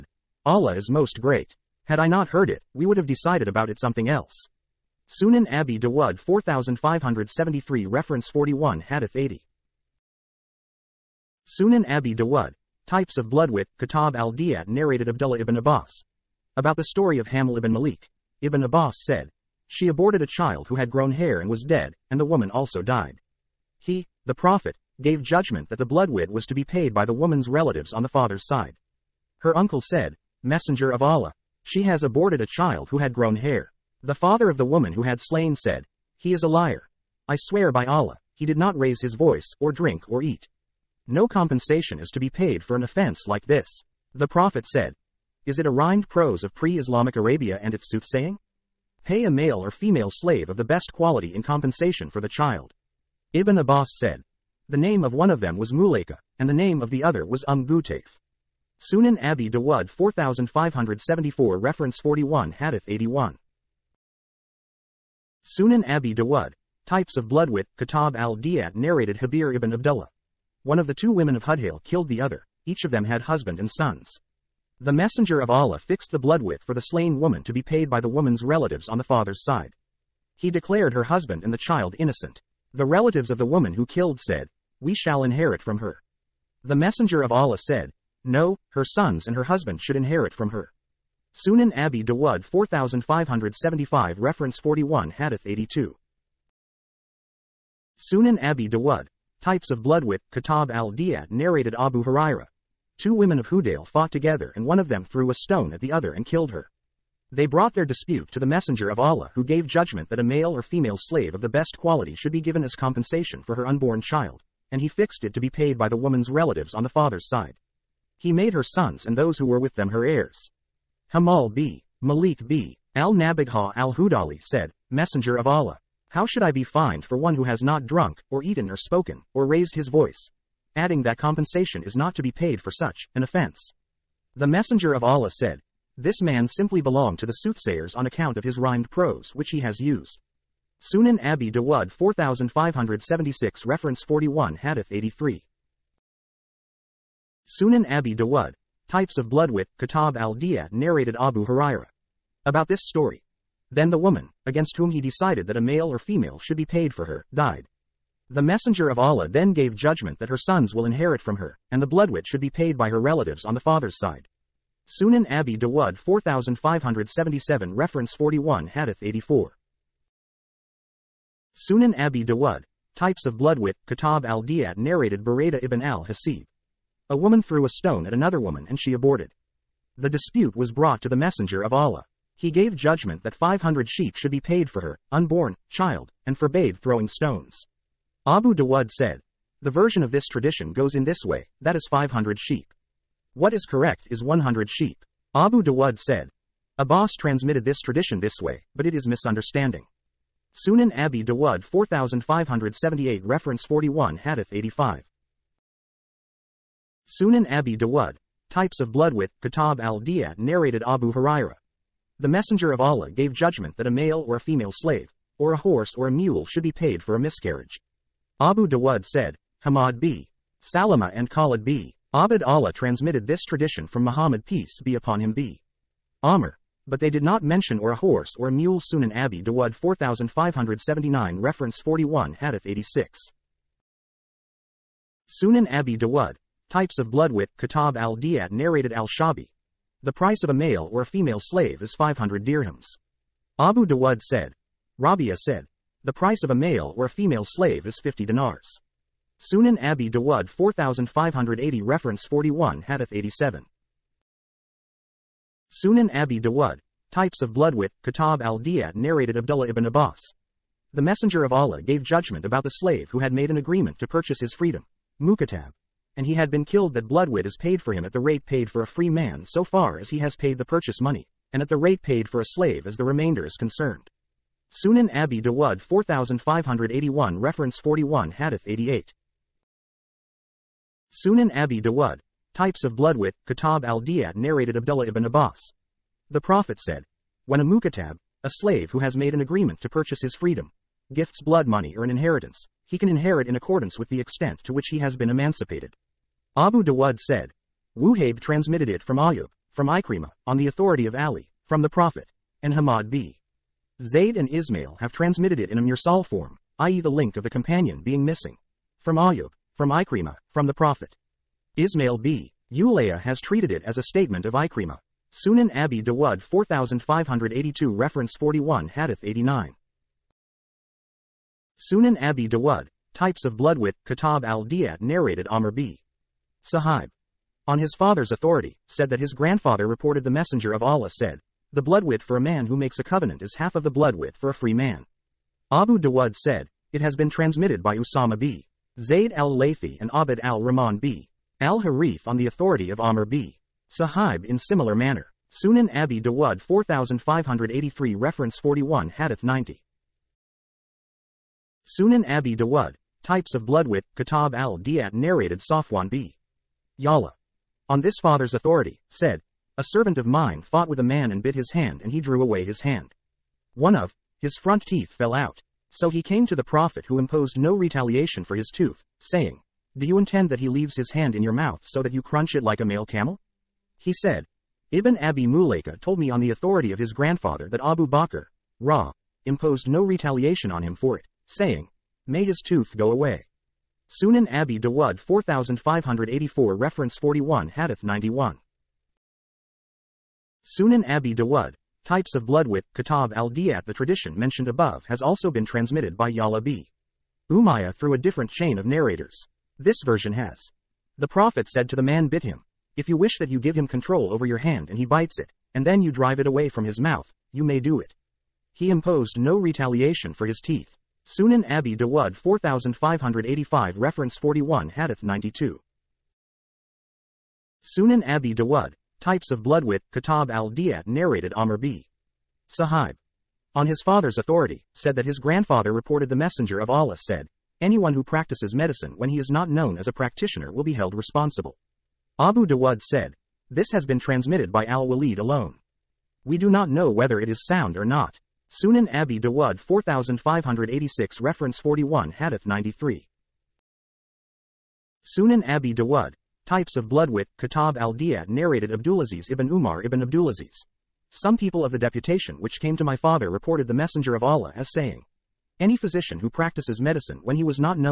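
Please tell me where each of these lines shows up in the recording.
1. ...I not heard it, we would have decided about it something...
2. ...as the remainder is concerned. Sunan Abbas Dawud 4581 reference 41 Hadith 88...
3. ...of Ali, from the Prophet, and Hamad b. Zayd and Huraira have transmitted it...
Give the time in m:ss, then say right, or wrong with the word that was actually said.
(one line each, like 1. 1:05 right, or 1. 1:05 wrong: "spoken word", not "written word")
1. 0:01 right
2. 4:32 wrong: "Abi", not "Abbas"
3. 5:01 wrong: "Ismail", not "Huraira".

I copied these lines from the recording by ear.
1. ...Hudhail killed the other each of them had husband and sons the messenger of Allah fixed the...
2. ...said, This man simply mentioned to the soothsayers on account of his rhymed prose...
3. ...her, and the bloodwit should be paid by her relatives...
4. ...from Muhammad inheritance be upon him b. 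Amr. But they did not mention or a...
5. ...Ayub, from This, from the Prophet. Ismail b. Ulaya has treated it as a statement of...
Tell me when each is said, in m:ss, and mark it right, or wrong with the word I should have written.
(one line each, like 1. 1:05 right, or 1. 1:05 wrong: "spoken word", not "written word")
1. 1:11 right
2. 2:15 wrong: "belonged", not "mentioned"
3. 2:41 right
4. 3:43 wrong: "peace", not "inheritance"
5. 5:09 wrong: "Ikrimah", not "This".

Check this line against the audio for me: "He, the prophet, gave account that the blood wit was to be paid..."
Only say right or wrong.
wrong.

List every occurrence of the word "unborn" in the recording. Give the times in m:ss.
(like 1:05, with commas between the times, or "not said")
1:53, 3:05.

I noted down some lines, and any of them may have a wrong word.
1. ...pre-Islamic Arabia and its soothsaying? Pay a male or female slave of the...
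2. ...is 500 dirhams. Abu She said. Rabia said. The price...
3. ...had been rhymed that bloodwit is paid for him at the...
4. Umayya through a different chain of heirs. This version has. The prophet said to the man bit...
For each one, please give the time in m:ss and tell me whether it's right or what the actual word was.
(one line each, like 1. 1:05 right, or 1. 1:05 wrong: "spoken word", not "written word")
1. 0:46 right
2. 4:01 wrong: "Dawud", not "She"
3. 4:26 wrong: "killed", not "rhymed"
4. 6:37 wrong: "narrators", not "heirs".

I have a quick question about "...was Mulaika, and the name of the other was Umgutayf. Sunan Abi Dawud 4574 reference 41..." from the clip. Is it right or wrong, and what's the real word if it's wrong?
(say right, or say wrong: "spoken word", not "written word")
right.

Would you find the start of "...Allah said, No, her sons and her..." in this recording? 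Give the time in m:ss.
1:27.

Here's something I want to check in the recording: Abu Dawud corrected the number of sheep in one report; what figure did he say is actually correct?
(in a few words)
100 sheep.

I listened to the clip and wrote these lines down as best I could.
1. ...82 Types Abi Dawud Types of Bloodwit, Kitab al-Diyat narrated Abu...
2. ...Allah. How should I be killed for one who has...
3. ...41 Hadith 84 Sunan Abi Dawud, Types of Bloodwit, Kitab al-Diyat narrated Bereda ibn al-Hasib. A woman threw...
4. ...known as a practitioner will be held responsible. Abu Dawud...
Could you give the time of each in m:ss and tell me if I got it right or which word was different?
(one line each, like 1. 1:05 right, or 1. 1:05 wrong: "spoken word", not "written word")
1. 1:35 wrong: "Sunan", not "Types"
2. 2:05 wrong: "fined", not "killed"
3. 2:48 right
4. 7:09 right.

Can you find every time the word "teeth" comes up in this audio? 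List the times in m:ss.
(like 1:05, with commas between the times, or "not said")
6:04, 6:50.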